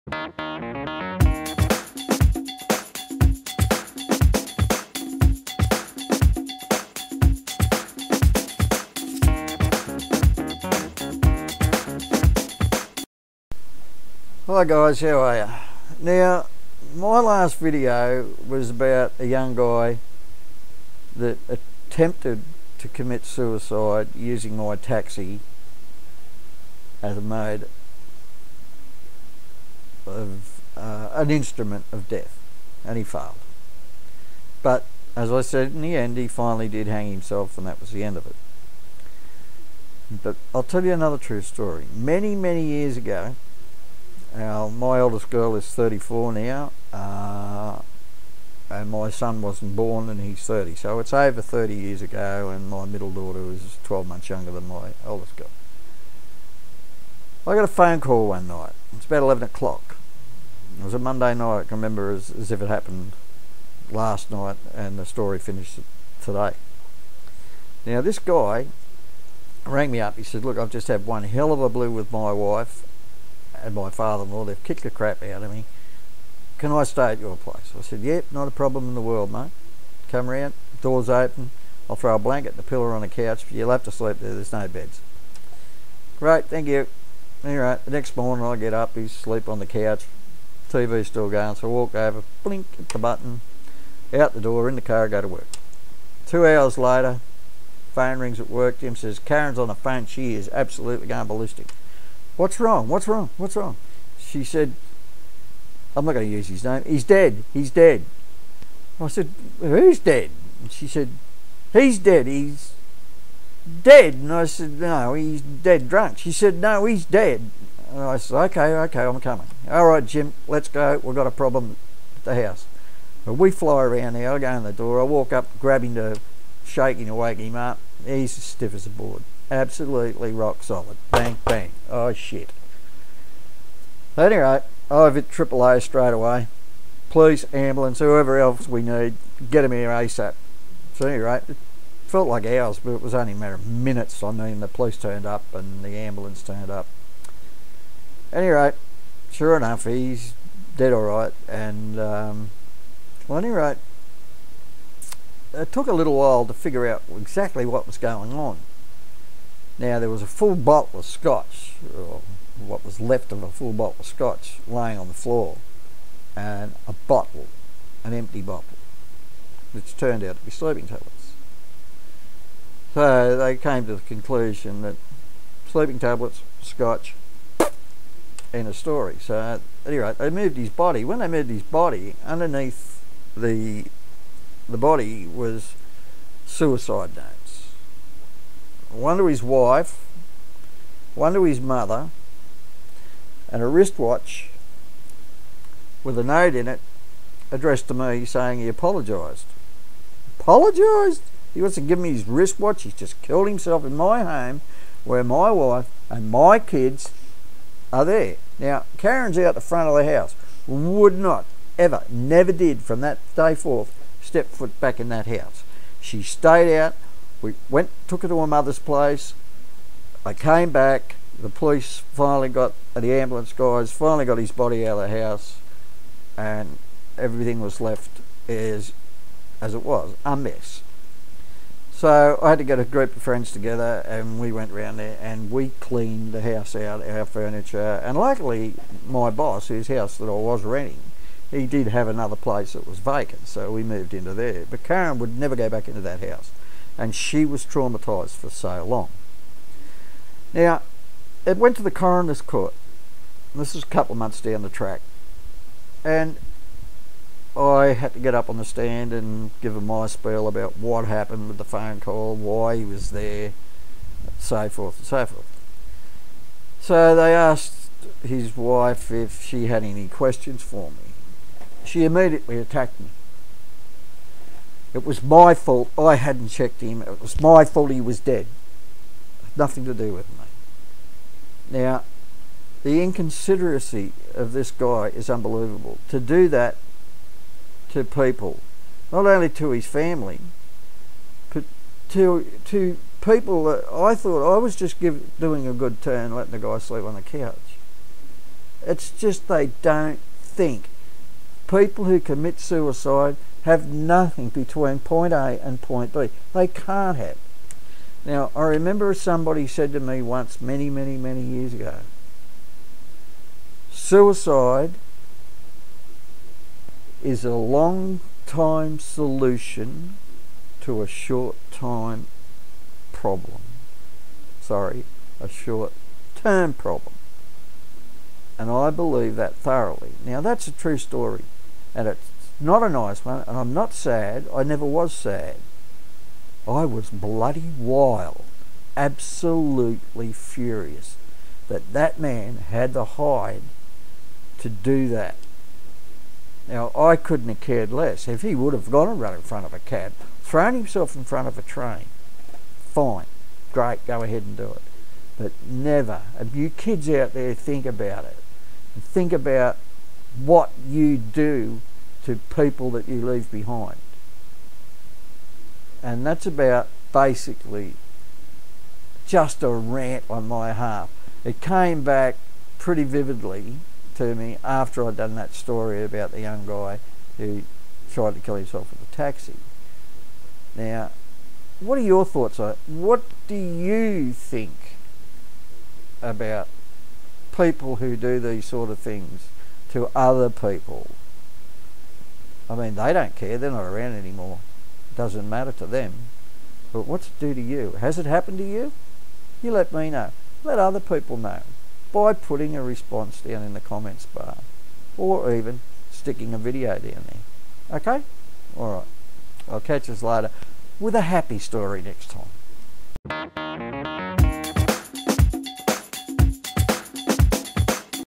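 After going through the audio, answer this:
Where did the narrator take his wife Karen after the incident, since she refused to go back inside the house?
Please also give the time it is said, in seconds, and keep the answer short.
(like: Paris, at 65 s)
Her mother's place, at 218 s.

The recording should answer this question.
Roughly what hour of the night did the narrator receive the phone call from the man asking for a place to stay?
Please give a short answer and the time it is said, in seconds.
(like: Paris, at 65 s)
11 o'clock, at 59 s.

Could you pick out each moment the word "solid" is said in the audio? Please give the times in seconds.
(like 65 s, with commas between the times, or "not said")
130 s.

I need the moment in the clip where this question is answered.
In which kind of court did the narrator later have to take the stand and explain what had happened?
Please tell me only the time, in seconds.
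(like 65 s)
251 s.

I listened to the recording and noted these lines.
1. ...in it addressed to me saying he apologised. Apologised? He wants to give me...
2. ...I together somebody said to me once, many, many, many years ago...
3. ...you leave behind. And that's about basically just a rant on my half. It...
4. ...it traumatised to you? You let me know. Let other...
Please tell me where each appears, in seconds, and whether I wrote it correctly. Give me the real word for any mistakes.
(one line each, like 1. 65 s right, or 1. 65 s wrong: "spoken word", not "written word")
1. 196 s right
2. 308 s wrong: "remember", not "together"
3. 363 s right
4. 398 s wrong: "happened", not "traumatised".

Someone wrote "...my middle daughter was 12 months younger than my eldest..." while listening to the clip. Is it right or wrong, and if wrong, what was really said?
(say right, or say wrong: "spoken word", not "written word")
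right.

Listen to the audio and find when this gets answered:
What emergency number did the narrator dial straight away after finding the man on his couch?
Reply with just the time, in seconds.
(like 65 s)
135 s.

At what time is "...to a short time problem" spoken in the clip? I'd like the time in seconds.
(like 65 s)
320 s.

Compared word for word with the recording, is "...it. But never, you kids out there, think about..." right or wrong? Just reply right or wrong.
right.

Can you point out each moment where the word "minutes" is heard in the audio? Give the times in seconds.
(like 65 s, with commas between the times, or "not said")
143 s.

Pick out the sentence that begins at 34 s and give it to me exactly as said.
But as I said, in the end, he finally did hang himself, and that was the end of it.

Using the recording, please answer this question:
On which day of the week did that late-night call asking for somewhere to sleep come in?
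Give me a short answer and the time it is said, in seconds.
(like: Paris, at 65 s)
Monday, at 60 s.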